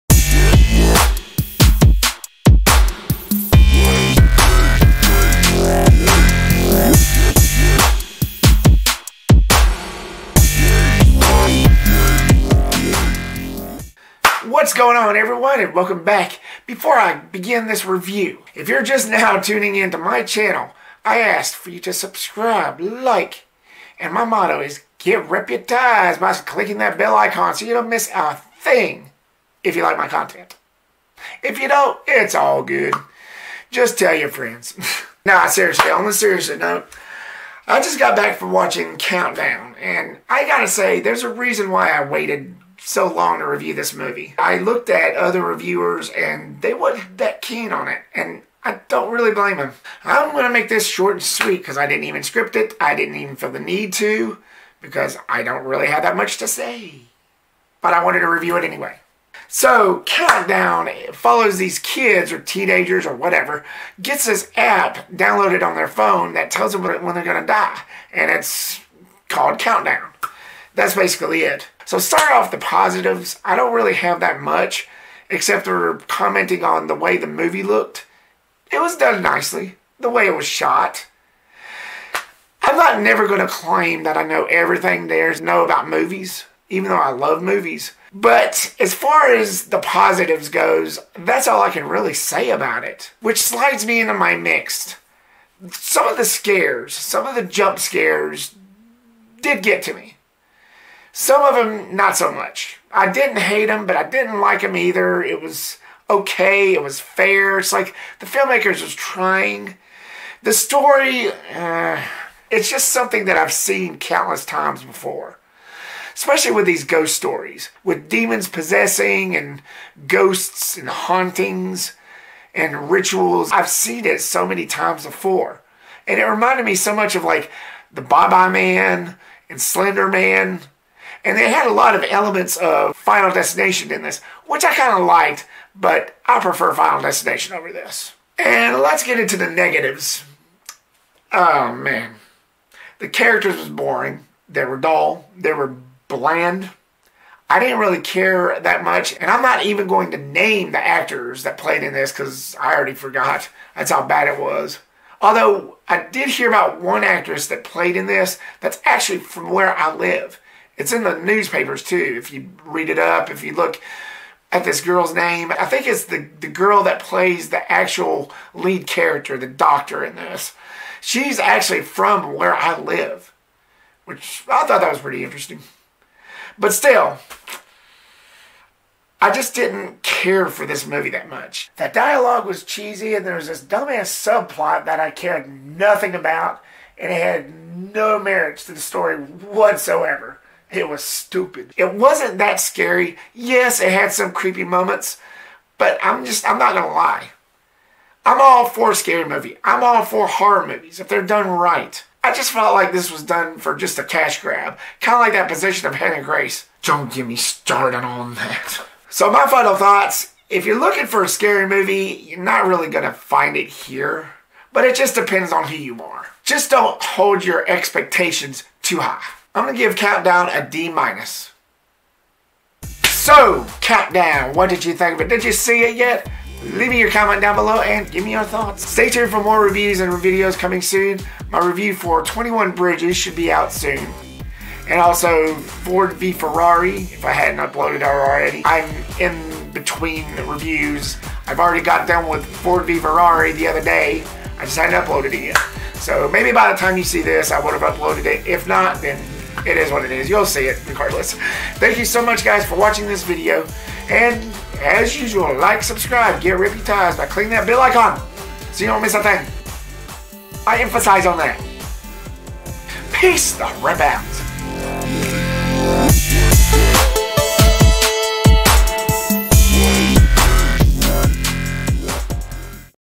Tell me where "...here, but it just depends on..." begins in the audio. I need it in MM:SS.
03:33.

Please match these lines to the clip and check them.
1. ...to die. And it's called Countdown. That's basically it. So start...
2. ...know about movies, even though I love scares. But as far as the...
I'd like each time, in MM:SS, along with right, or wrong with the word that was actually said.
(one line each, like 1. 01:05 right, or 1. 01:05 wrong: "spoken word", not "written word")
1. 01:07 right
2. 01:25 wrong: "movies", not "scares".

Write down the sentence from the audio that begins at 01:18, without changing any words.
It was done nicely, the way it was shot.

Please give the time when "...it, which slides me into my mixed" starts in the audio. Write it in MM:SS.
01:32.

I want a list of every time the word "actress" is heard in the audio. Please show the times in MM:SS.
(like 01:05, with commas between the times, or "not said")
02:37.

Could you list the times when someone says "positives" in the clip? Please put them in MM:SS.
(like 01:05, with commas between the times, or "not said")
01:12, 01:29.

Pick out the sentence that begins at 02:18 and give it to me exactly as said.
And let's get into the negatives.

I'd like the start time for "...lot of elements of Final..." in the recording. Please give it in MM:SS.
02:11.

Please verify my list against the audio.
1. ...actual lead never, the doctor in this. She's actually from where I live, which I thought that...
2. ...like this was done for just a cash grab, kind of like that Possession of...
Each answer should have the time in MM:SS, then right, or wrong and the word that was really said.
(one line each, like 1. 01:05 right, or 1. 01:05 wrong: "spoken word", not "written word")
1. 02:47 wrong: "character", not "never"
2. 03:22 right.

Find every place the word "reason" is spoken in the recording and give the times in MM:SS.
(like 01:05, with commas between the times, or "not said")
00:41.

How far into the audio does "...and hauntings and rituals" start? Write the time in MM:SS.
02:00.